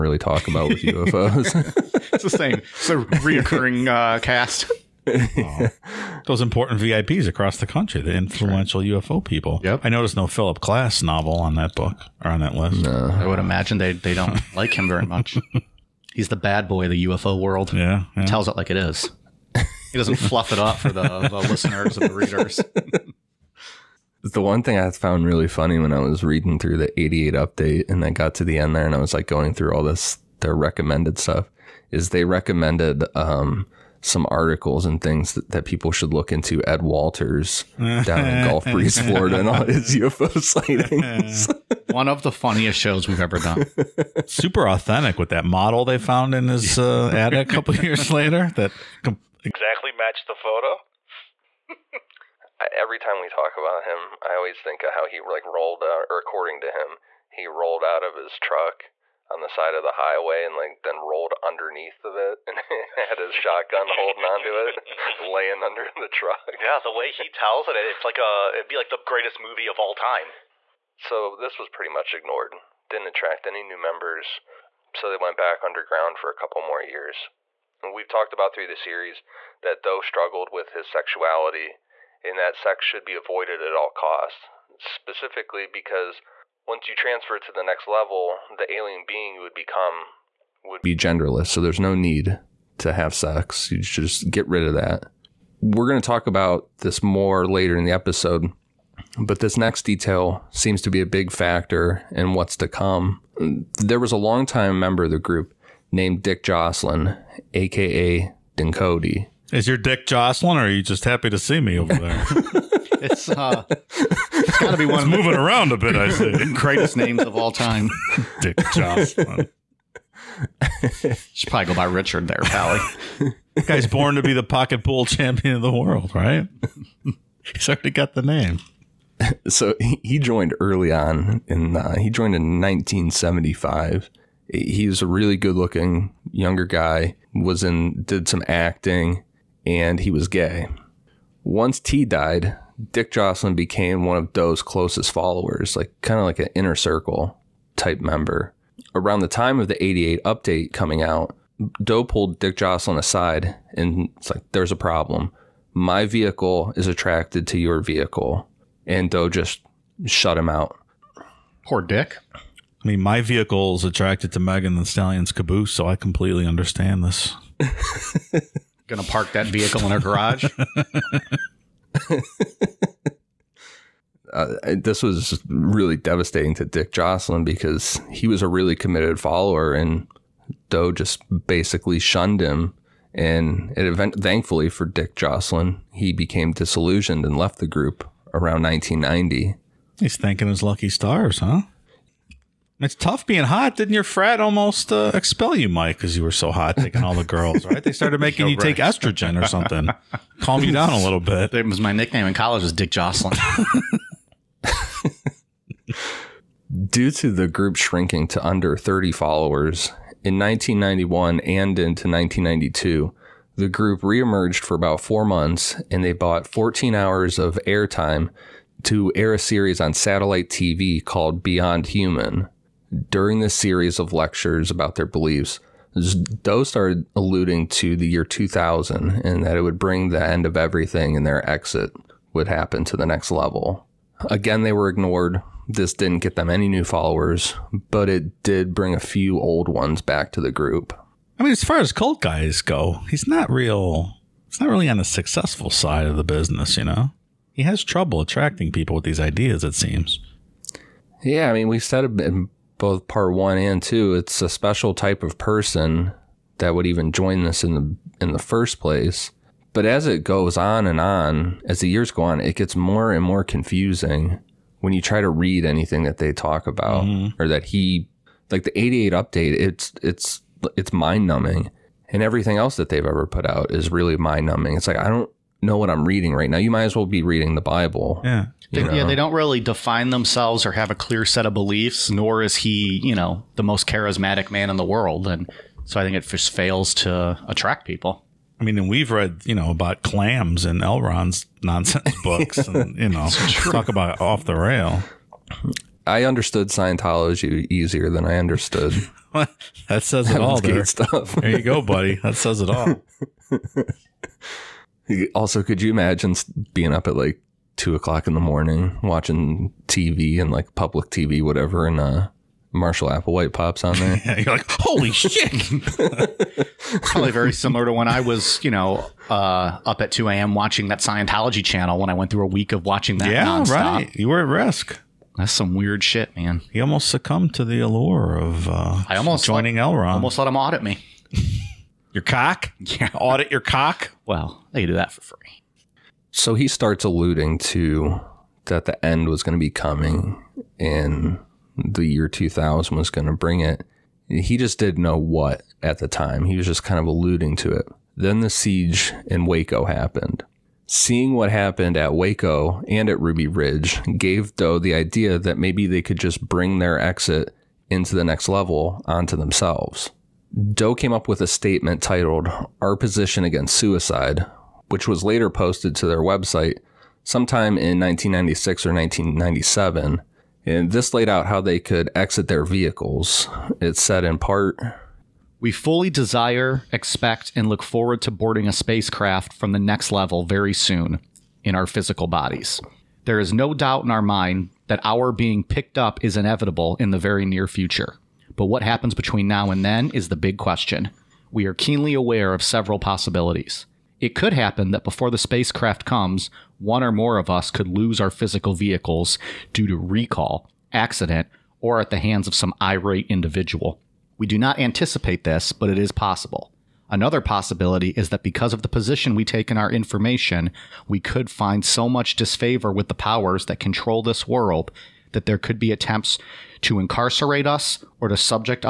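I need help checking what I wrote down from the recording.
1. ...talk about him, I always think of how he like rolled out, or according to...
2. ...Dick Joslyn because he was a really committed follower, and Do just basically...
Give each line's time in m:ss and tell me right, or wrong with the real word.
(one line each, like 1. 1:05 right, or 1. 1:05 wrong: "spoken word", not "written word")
1. 0:53 right
2. 2:56 right.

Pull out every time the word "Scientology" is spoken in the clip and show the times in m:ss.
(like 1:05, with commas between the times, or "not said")
4:56, 5:20.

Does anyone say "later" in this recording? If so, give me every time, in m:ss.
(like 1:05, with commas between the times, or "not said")
0:48, 1:37, 6:05.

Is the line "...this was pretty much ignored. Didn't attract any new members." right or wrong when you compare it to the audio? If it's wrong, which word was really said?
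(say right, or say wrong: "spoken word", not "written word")
right.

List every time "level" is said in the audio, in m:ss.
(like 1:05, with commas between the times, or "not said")
1:27, 3:53, 5:58, 6:20.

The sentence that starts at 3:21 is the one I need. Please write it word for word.
It was my nickname in college was Dick Joslyn.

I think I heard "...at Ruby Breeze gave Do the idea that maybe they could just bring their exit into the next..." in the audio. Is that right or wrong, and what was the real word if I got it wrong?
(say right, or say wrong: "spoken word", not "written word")
wrong: "Ridge", not "Breeze".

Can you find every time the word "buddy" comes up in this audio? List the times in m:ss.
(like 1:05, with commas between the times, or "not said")
5:01.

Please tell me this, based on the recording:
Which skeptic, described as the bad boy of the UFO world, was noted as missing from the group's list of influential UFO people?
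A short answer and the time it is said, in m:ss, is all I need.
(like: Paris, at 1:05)
Philip Klass, at 0:10.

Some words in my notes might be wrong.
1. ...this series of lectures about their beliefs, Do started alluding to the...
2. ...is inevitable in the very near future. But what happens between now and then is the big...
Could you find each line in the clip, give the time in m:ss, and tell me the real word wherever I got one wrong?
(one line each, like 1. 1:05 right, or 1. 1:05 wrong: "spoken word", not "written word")
1. 3:43 right
2. 6:26 right.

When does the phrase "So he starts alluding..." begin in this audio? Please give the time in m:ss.
5:36.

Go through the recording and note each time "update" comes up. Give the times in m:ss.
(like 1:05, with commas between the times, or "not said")
0:27, 2:30, 4:29.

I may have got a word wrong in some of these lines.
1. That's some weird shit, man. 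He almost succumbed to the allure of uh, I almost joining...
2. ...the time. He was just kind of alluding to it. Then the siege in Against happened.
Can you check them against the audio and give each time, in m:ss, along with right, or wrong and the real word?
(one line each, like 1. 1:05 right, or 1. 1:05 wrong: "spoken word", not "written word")
1. 5:25 right
2. 5:45 wrong: "Waco", not "Against".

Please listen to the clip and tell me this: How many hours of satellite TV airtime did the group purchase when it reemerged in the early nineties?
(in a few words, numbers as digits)
14.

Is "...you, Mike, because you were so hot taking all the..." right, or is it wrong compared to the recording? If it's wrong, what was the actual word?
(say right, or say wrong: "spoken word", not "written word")
right.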